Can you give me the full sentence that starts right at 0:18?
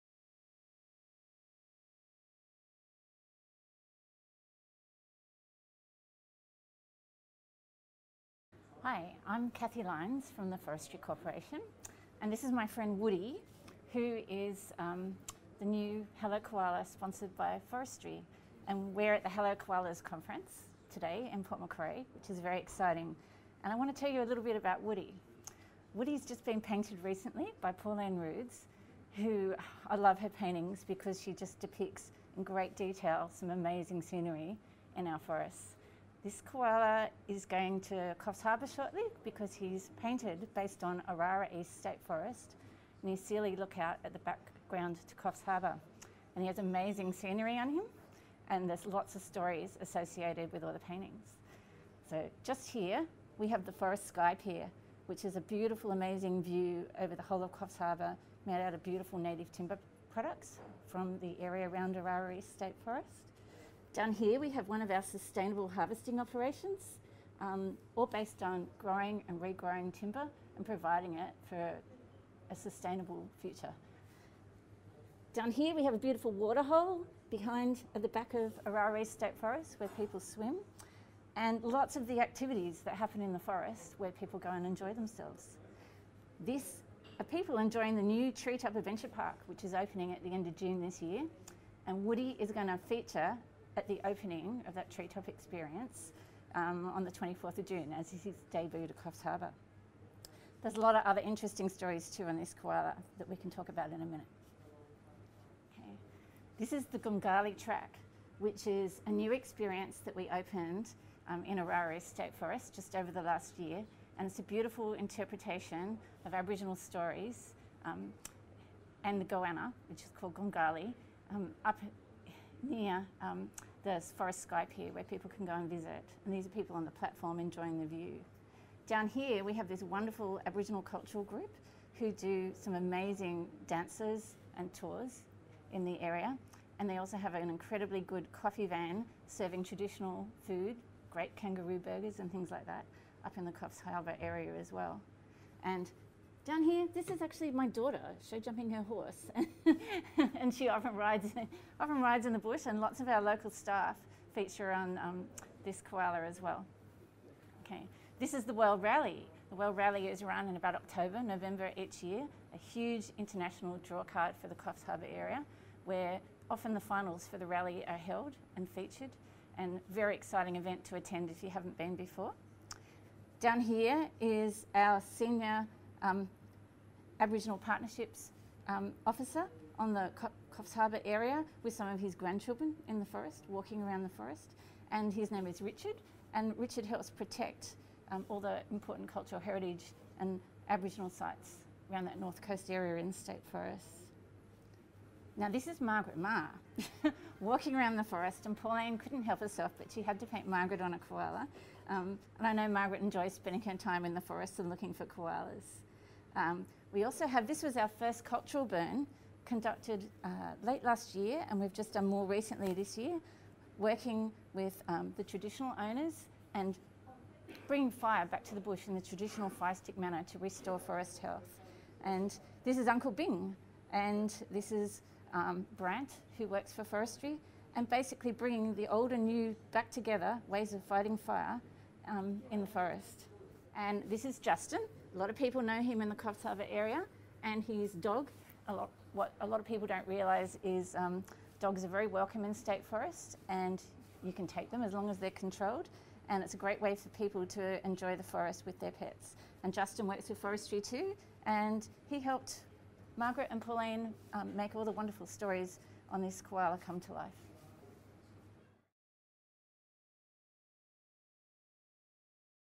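And we're at the Hello Koalas conference today in Port Macquarie, which is very exciting.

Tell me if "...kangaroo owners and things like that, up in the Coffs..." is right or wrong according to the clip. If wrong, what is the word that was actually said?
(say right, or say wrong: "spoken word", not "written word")
wrong: "burgers", not "owners".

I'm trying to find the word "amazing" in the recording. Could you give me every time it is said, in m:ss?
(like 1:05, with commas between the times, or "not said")
0:33, 0:46, 0:55, 2:12.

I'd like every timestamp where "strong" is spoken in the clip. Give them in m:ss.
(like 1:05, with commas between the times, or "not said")
not said.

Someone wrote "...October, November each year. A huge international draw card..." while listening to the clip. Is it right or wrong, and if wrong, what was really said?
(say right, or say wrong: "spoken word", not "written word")
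right.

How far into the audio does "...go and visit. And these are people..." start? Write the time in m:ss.
2:05.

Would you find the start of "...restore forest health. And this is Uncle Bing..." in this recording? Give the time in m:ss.
3:40.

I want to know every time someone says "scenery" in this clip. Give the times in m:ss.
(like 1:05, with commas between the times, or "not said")
0:34, 0:47.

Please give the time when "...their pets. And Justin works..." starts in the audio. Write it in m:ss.
4:08.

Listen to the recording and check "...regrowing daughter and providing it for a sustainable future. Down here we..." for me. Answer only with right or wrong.
wrong.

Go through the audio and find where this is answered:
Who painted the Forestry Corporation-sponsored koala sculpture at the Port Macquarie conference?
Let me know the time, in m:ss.
0:27.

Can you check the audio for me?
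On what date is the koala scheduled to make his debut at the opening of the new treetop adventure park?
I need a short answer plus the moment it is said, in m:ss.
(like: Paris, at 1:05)
24th of June, at 1:37.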